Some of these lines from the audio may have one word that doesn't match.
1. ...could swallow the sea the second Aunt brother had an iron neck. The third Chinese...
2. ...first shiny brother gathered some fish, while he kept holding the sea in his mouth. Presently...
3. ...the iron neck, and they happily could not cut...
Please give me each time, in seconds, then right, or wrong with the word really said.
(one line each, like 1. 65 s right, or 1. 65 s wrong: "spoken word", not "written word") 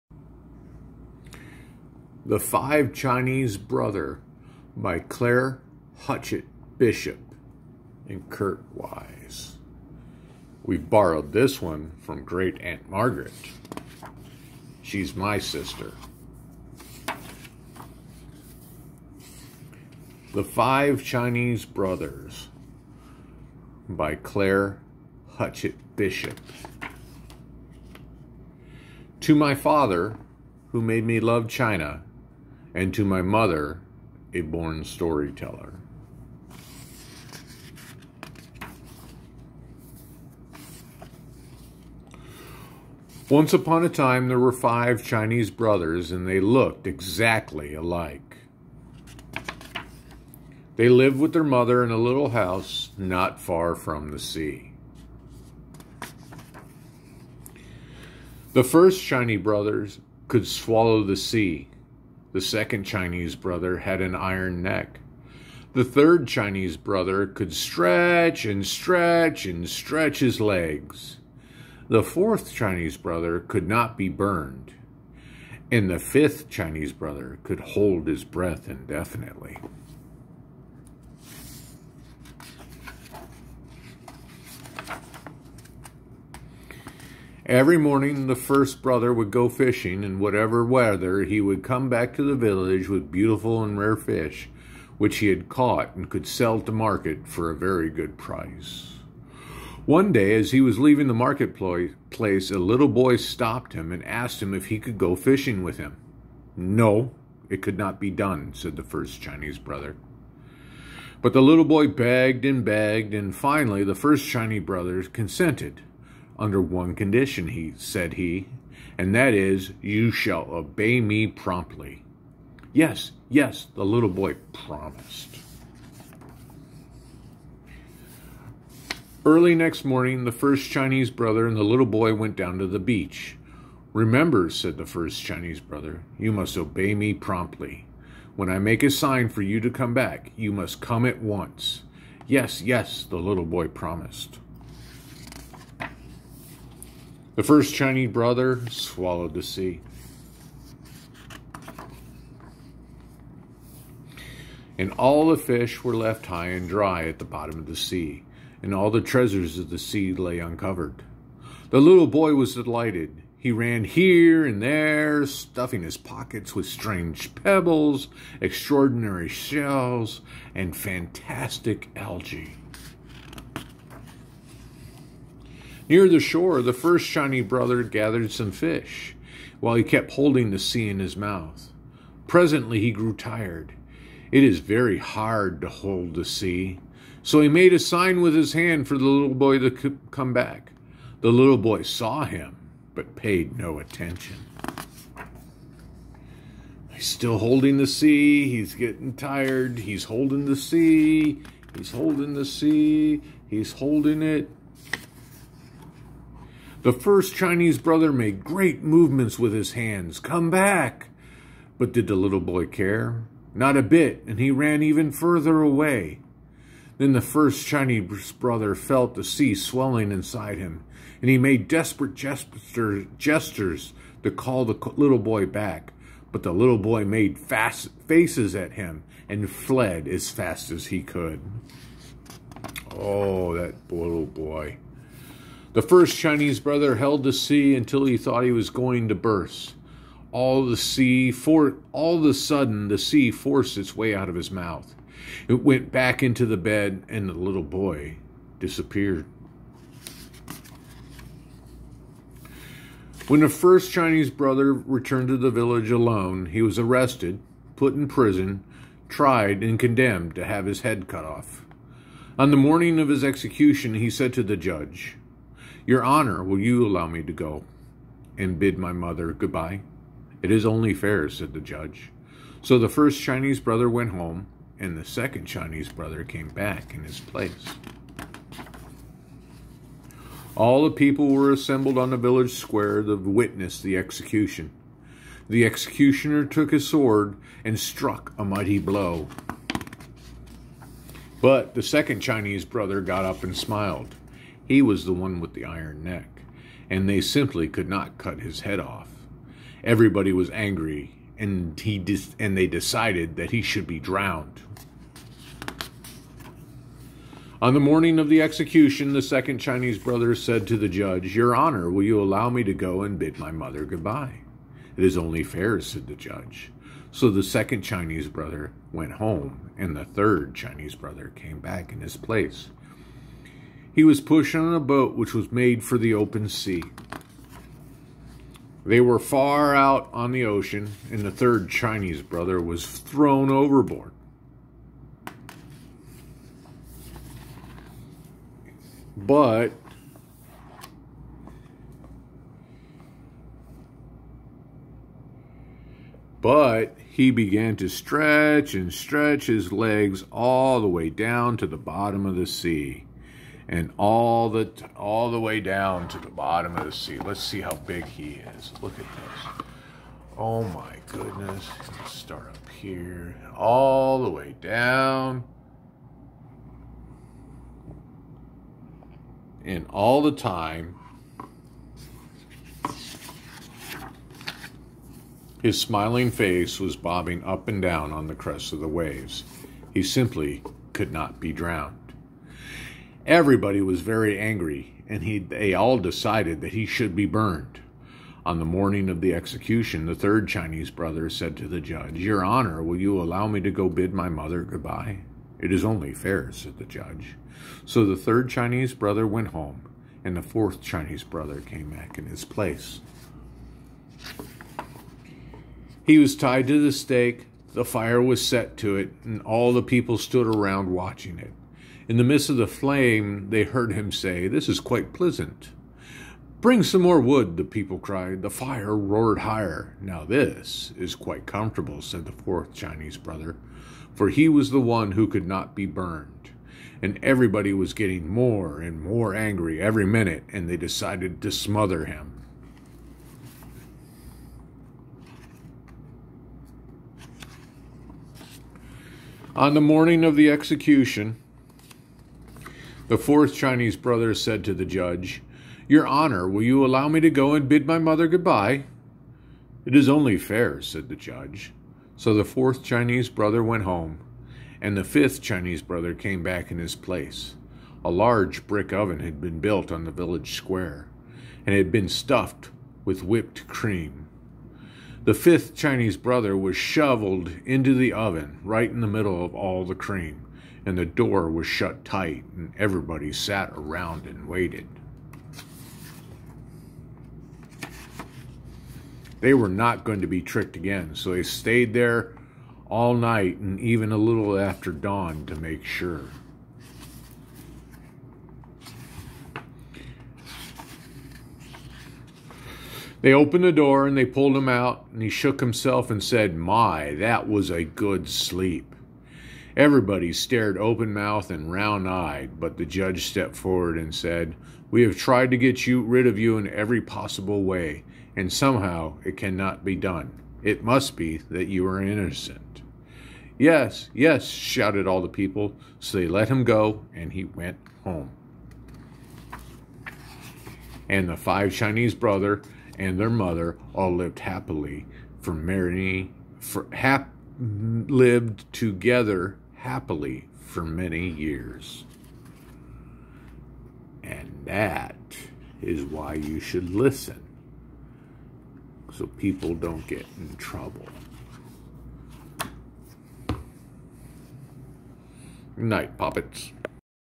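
1. 60 s wrong: "Chinese", not "Aunt"
2. 176 s right
3. 295 s wrong: "simply", not "happily".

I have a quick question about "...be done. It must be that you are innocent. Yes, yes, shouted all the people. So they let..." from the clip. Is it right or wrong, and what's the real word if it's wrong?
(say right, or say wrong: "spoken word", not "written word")
right.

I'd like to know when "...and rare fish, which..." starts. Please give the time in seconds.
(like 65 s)
93 s.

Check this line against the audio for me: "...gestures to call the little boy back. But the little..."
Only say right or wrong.
right.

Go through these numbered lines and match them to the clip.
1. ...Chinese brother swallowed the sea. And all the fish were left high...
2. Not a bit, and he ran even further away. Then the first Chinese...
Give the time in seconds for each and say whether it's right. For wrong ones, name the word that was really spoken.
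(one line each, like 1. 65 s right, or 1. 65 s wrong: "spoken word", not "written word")
1. 147 s right
2. 213 s right.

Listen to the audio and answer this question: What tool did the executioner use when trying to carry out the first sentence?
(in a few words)
sword.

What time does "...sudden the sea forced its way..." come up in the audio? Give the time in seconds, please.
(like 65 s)
242 s.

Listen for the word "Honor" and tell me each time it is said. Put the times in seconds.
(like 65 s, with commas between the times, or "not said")
266 s, 311 s, 392 s, 446 s.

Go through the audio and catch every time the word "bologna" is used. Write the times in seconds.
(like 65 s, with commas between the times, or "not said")
not said.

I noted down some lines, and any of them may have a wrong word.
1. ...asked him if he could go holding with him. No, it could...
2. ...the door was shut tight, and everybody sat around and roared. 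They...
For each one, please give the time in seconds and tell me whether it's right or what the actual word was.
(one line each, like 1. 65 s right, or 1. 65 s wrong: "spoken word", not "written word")
1. 104 s wrong: "fishing", not "holding"
2. 470 s wrong: "waited", not "roared".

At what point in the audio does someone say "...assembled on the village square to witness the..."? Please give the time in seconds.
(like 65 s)
281 s.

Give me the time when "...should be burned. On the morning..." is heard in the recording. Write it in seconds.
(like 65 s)
386 s.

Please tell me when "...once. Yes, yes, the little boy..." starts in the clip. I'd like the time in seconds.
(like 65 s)
141 s.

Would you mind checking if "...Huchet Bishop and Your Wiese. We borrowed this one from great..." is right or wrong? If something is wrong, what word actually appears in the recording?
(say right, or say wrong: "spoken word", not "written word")
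wrong: "Kurt", not "Your".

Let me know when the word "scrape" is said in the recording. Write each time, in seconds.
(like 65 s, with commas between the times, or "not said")
not said.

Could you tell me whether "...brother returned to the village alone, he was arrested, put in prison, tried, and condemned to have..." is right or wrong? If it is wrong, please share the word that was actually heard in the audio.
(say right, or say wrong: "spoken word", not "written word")
right.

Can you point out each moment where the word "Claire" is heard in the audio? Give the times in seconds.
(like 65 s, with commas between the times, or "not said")
4 s, 24 s.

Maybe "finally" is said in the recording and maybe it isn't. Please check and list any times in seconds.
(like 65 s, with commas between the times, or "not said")
113 s.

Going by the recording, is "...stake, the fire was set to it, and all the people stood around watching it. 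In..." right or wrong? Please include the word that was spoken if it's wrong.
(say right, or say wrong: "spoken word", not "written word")
right.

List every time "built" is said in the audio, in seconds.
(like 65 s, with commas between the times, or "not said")
459 s.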